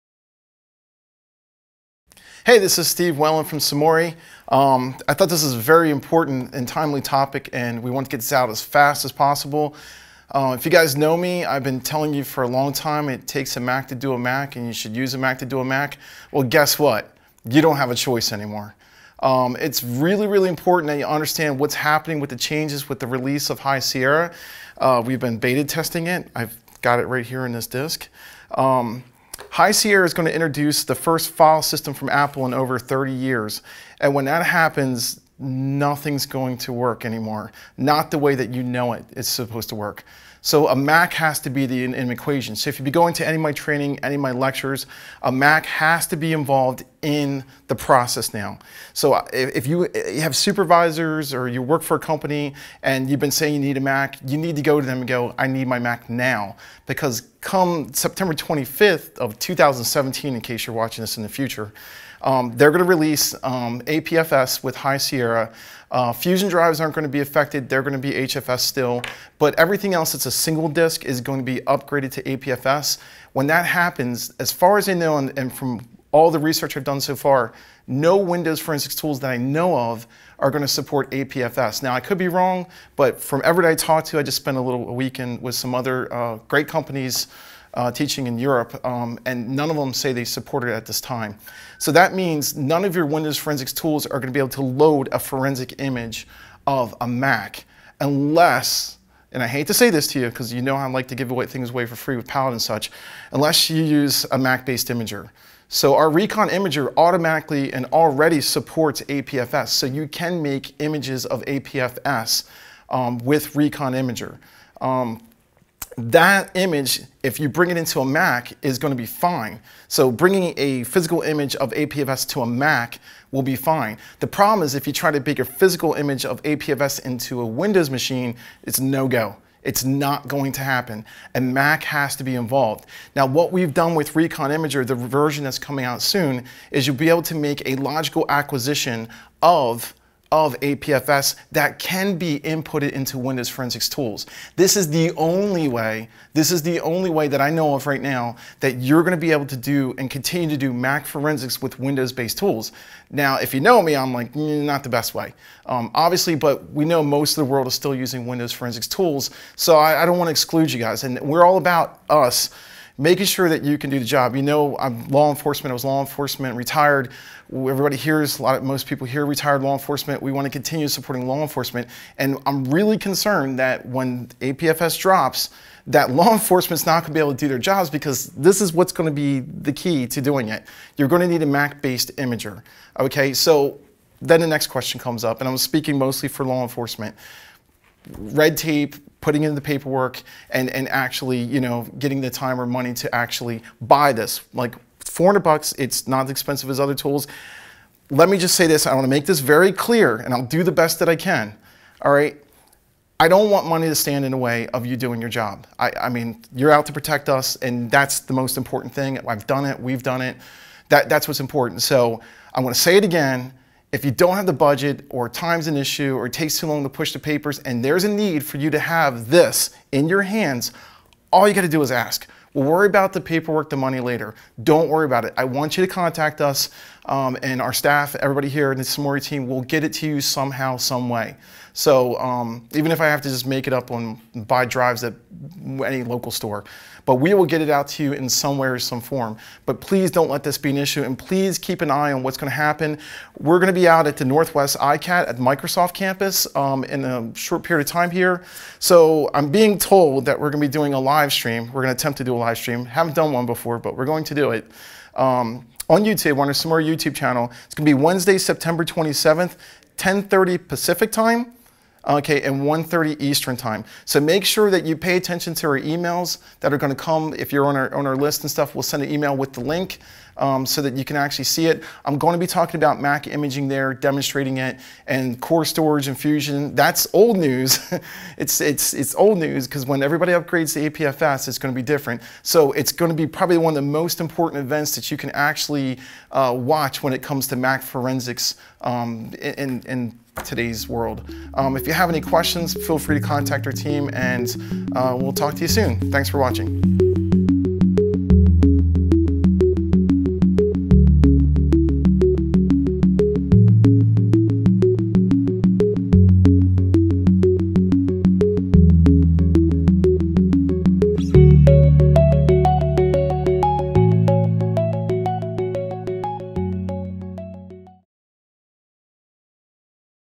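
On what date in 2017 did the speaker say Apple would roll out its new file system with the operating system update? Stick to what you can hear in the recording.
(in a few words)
September 25th.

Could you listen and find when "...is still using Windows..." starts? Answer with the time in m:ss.
2:37.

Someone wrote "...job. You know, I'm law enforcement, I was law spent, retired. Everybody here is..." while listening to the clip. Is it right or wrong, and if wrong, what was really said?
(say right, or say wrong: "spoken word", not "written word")
wrong: "enforcement", not "spent".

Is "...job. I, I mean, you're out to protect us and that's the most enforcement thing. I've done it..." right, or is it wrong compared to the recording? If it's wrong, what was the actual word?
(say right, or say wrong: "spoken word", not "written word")
wrong: "important", not "enforcement".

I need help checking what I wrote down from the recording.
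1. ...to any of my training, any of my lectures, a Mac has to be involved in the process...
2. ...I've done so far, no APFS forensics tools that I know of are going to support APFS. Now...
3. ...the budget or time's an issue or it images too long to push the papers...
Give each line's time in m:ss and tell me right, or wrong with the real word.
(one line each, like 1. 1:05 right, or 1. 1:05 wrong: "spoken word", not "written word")
1. 0:43 right
2. 1:16 wrong: "Windows", not "APFS"
3. 3:34 wrong: "takes", not "images".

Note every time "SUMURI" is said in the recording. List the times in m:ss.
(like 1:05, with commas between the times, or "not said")
0:03, 3:48, 4:16.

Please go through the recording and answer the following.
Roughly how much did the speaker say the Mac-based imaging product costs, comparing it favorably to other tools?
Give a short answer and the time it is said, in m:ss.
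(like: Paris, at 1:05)
$400, at 3:15.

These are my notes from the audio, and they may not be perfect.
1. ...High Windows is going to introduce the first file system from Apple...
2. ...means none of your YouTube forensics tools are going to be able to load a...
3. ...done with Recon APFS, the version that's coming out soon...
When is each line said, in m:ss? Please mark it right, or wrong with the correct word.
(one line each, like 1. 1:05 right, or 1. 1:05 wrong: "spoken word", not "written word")
1. 0:29 wrong: "Sierra", not "Windows"
2. 1:32 wrong: "Windows", not "YouTube"
3. 2:13 wrong: "Imager", not "APFS".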